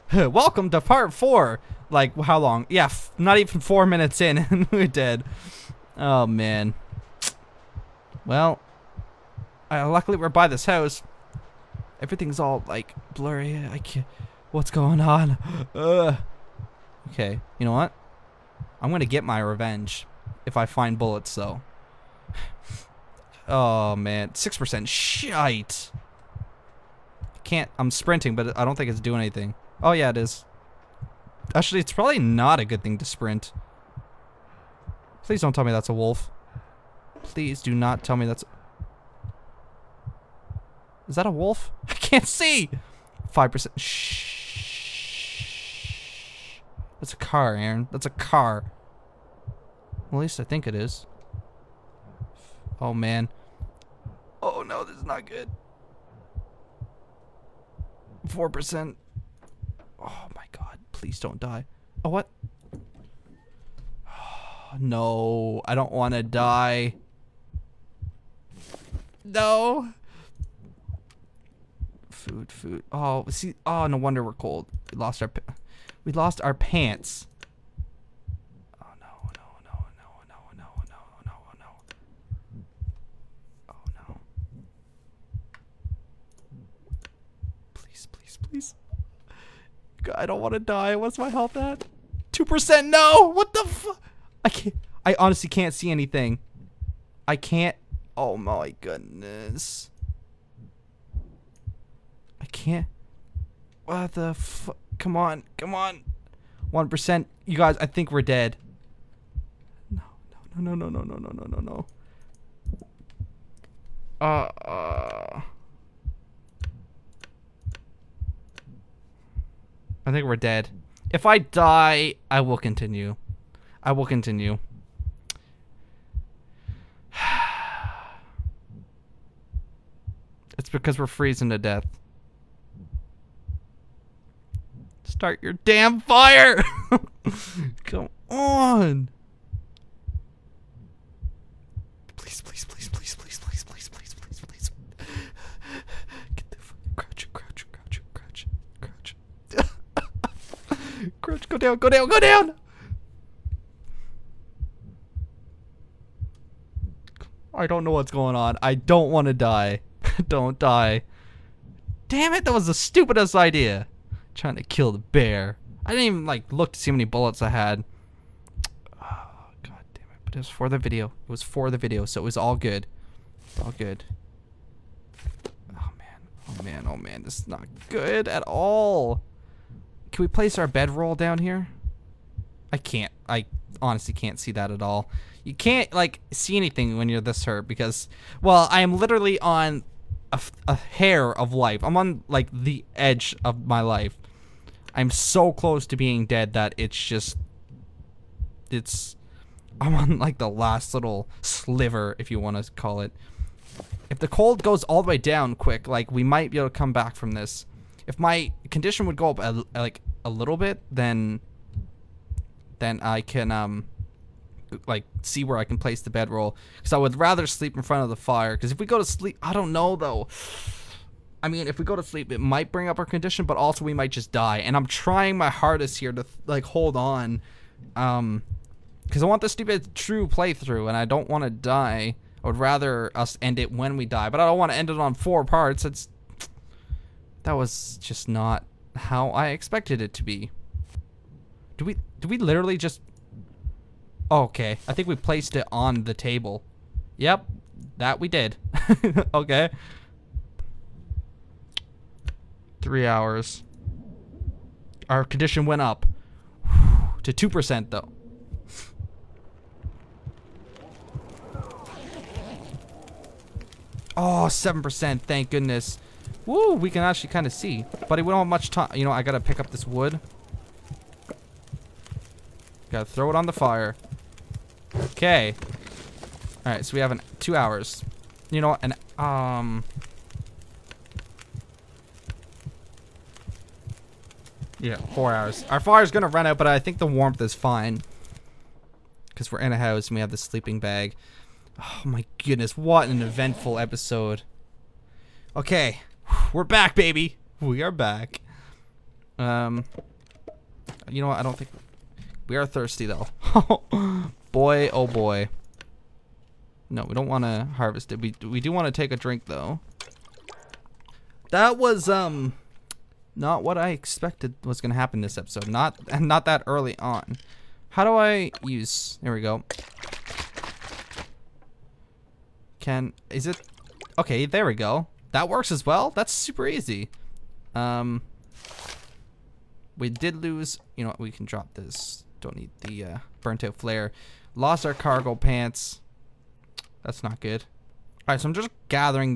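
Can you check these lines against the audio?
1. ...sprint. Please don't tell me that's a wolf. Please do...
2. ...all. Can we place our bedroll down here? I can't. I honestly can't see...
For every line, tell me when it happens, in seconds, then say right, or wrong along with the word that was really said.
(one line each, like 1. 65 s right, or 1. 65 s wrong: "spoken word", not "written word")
1. 33 s right
2. 178 s right.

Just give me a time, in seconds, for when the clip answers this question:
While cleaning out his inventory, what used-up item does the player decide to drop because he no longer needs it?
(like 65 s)
333 s.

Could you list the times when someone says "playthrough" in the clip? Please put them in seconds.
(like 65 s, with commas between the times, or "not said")
230 s.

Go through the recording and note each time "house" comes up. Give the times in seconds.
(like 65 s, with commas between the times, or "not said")
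10 s, 289 s.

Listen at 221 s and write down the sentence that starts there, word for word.
I mean, if we go to sleep, it might bring up our condition, but also we might just die.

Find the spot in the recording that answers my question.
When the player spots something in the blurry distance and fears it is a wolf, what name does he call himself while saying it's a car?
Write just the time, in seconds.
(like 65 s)
47 s.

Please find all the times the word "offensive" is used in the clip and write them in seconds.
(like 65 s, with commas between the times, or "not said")
not said.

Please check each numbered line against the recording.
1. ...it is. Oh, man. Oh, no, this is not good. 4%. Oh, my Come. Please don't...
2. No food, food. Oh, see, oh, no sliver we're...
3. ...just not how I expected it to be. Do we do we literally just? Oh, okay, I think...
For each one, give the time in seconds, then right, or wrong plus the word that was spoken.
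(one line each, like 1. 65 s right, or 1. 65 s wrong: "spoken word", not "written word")
1. 50 s wrong: "God", not "Come"
2. 69 s wrong: "wonder", not "sliver"
3. 238 s right.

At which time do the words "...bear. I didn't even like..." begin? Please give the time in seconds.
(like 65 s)
164 s.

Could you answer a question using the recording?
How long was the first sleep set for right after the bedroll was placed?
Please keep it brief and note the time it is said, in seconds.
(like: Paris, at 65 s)
3 hours, at 252 s.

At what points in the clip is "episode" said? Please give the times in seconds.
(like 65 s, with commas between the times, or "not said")
293 s, 315 s.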